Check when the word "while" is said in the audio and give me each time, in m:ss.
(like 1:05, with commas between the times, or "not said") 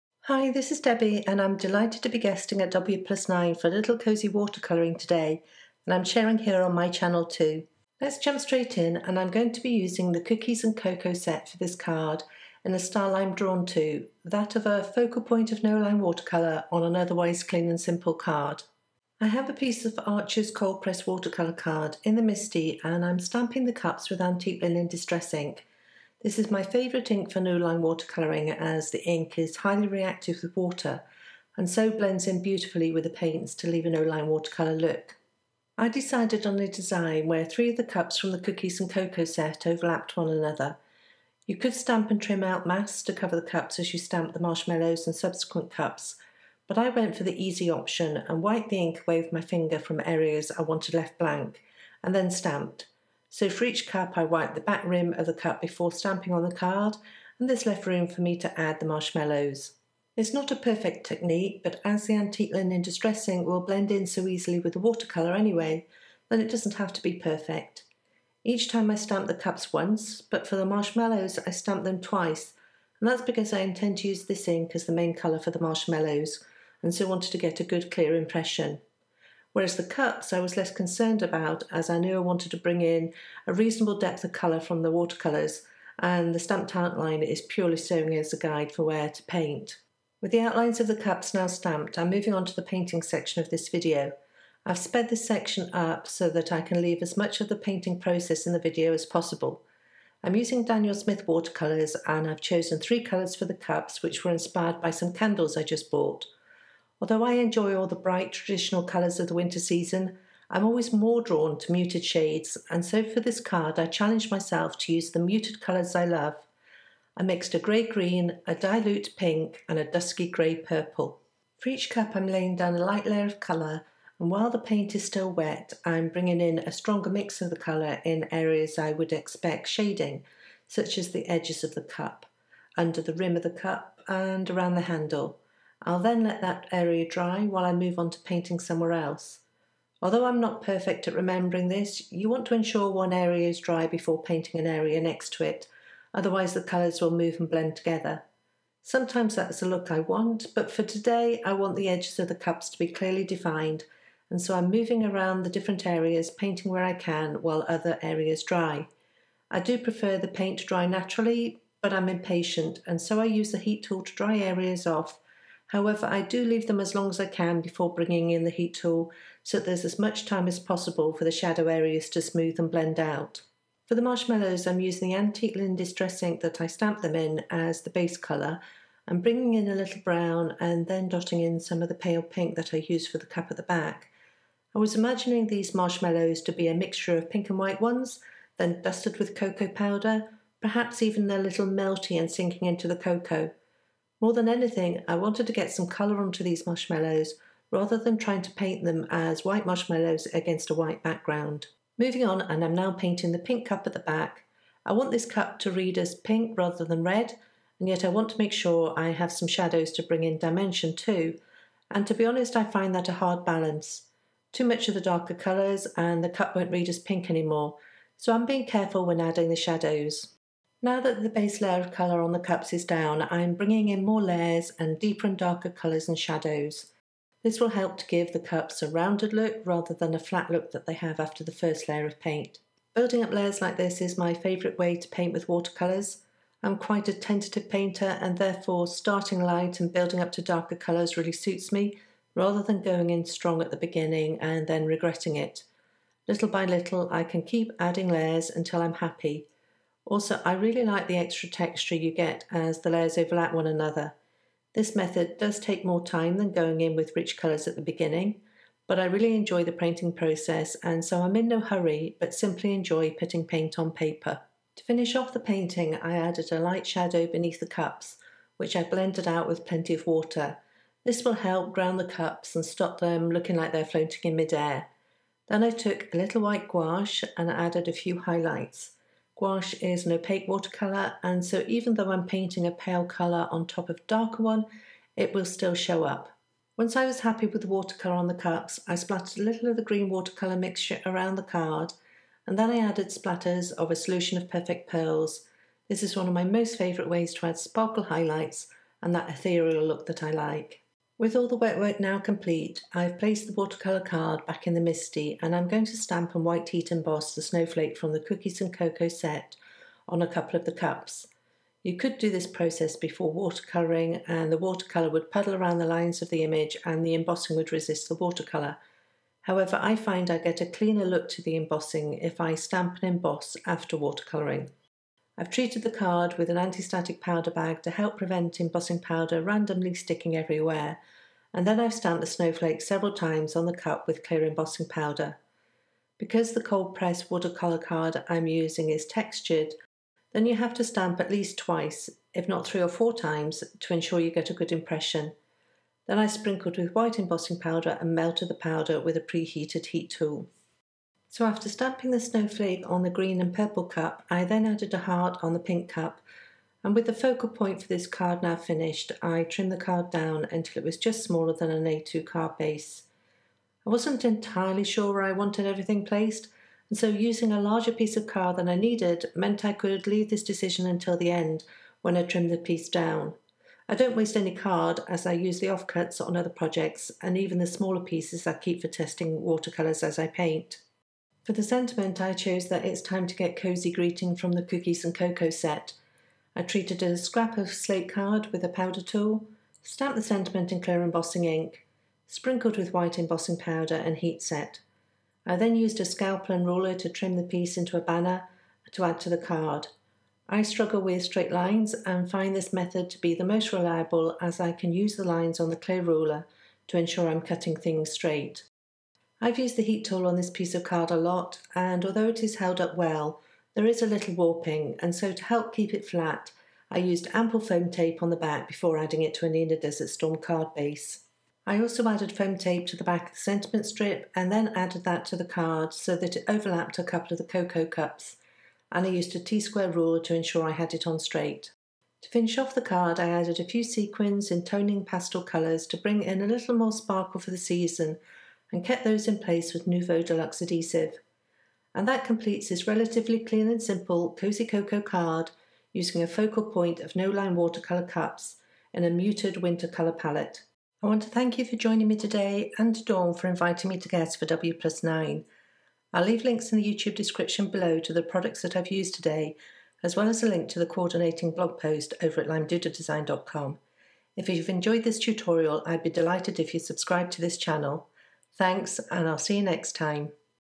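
2:04, 2:17, 2:37.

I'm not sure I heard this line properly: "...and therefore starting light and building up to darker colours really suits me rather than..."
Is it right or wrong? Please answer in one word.
right.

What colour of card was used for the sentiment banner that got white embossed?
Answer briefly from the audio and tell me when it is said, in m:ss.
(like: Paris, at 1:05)
slate, at 6:27.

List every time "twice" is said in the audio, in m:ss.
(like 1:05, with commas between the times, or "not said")
1:12, 5:41.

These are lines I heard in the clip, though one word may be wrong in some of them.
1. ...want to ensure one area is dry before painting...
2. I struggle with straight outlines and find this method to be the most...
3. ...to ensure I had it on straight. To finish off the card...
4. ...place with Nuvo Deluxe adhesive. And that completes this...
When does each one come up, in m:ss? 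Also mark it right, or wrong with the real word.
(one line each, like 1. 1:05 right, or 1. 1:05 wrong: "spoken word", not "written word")
1. 2:22 right
2. 6:40 wrong: "lines", not "outlines"
3. 7:10 right
4. 7:19 right.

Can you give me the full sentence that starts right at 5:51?
So after stamping the snowflake on the green and purple cup, I then added a heart on the pink cup.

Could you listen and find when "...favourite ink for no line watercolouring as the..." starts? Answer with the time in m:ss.
0:26.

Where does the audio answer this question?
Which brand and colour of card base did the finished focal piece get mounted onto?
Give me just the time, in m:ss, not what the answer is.
6:59.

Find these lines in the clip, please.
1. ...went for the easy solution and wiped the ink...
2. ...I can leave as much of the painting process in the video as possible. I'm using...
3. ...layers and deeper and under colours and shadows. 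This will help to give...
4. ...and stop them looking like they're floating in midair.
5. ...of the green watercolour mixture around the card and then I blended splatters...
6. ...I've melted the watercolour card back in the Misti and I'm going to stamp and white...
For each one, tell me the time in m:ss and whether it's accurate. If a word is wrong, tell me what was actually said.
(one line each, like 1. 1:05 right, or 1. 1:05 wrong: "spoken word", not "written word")
1. 0:46 wrong: "option", not "solution"
2. 1:36 right
3. 3:44 wrong: "darker", not "under"
4. 4:32 right
5. 4:49 wrong: "added", not "blended"
6. 5:02 wrong: "placed", not "melted".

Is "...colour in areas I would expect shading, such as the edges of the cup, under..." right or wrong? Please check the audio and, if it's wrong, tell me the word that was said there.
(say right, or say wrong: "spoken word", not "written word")
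right.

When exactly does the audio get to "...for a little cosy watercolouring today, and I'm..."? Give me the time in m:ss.
0:03.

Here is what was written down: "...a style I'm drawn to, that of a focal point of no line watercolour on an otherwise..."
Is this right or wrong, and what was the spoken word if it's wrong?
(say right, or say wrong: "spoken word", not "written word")
right.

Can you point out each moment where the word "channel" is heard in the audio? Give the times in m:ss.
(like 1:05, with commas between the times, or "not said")
0:06, 7:47.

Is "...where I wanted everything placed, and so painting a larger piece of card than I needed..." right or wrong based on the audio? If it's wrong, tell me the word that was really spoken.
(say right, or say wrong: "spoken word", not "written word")
wrong: "using", not "painting".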